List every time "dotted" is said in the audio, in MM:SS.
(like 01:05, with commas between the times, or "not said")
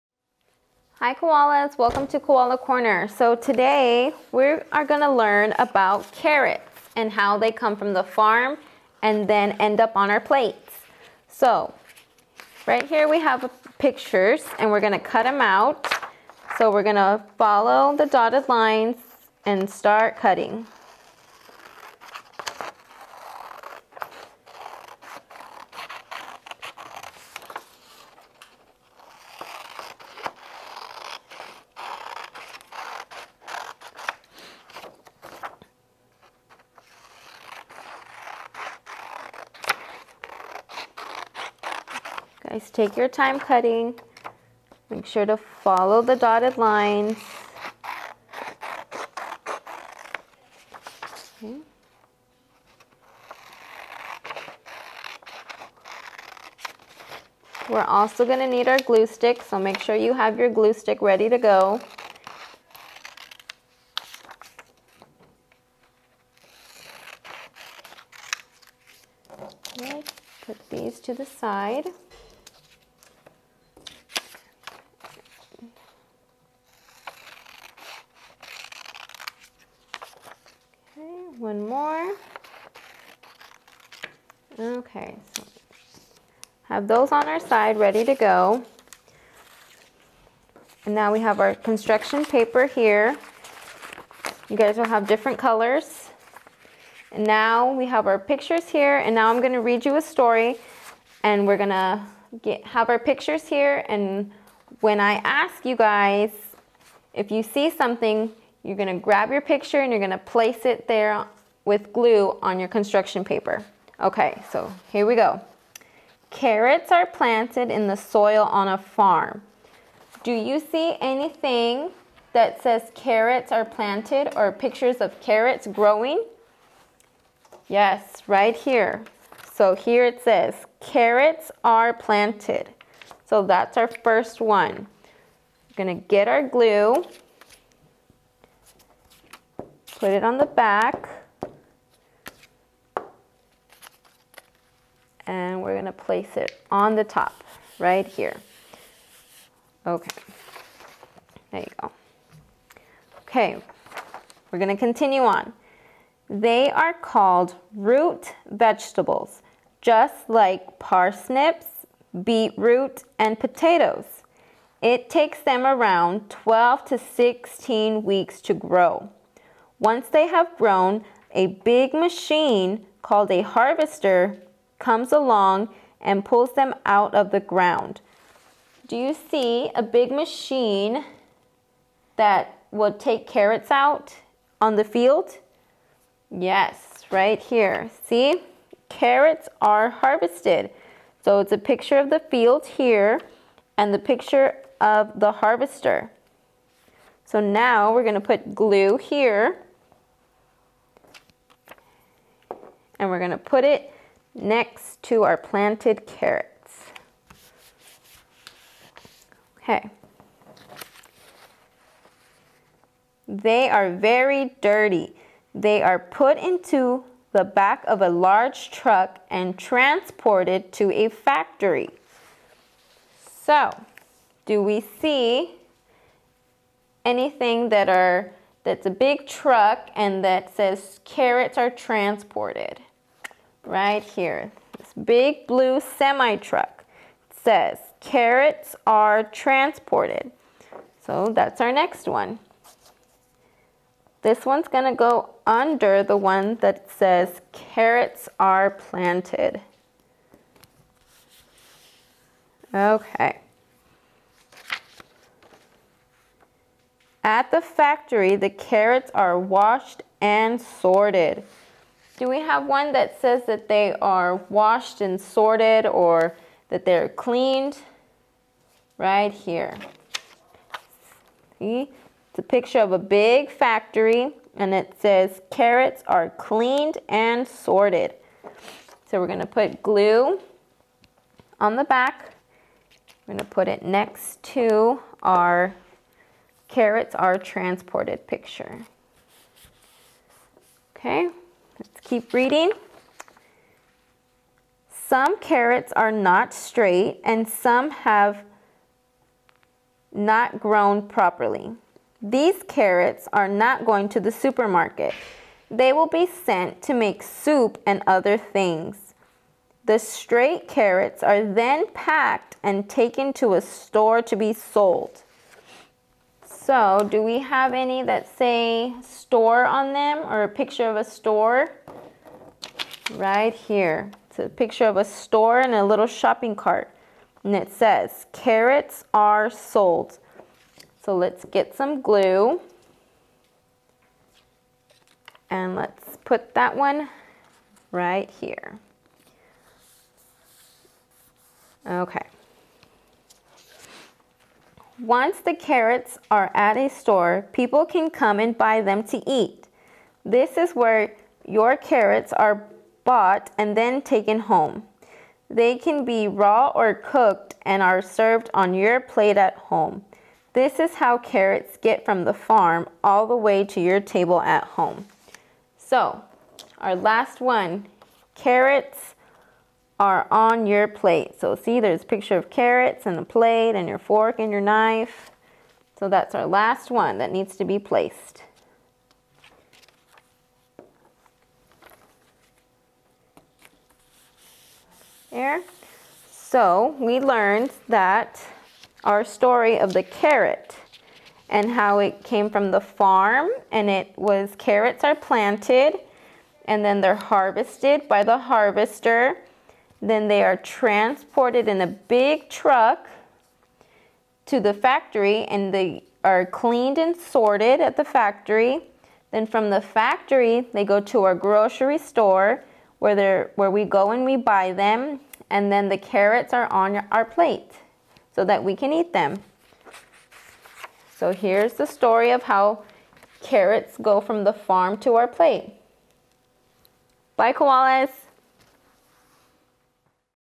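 00:18, 00:46.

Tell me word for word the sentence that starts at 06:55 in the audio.
And then the carrots are on our plate so that we can eat them.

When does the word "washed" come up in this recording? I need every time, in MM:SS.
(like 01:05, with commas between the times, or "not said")
04:19, 04:24.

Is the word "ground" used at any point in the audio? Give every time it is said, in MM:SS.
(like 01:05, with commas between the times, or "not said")
02:57.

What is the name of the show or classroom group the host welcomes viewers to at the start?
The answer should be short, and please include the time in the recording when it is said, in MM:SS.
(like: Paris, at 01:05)
Koala Corner, at 00:02.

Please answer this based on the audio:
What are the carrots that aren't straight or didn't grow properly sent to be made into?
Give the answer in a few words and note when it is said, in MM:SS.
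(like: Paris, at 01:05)
Soup, at 05:07.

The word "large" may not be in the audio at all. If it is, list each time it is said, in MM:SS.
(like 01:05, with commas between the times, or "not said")
03:38.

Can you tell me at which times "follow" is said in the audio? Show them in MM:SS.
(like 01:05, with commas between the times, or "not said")
00:17, 00:45.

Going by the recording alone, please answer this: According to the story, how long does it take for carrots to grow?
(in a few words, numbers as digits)
12 to 16 weeks.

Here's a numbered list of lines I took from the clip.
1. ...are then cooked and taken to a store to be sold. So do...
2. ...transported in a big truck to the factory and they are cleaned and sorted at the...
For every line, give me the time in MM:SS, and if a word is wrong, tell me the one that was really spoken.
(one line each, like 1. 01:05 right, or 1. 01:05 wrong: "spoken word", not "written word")
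1. 05:11 wrong: "packed", not "cooked"
2. 06:40 right.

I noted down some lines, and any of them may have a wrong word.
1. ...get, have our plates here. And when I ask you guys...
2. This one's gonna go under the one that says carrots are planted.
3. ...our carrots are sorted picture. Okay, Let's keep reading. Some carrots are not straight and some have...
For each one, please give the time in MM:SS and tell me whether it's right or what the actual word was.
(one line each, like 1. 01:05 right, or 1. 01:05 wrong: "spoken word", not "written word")
1. 01:42 wrong: "pictures", not "plates"
2. 04:04 right
3. 04:45 wrong: "transported", not "sorted".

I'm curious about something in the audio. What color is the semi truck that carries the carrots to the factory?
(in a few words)
Blue.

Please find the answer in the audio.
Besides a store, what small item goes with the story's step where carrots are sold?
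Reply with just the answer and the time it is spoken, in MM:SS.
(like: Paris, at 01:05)
Shopping cart, at 05:26.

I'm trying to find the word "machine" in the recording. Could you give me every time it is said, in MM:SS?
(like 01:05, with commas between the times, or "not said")
02:51, 03:00.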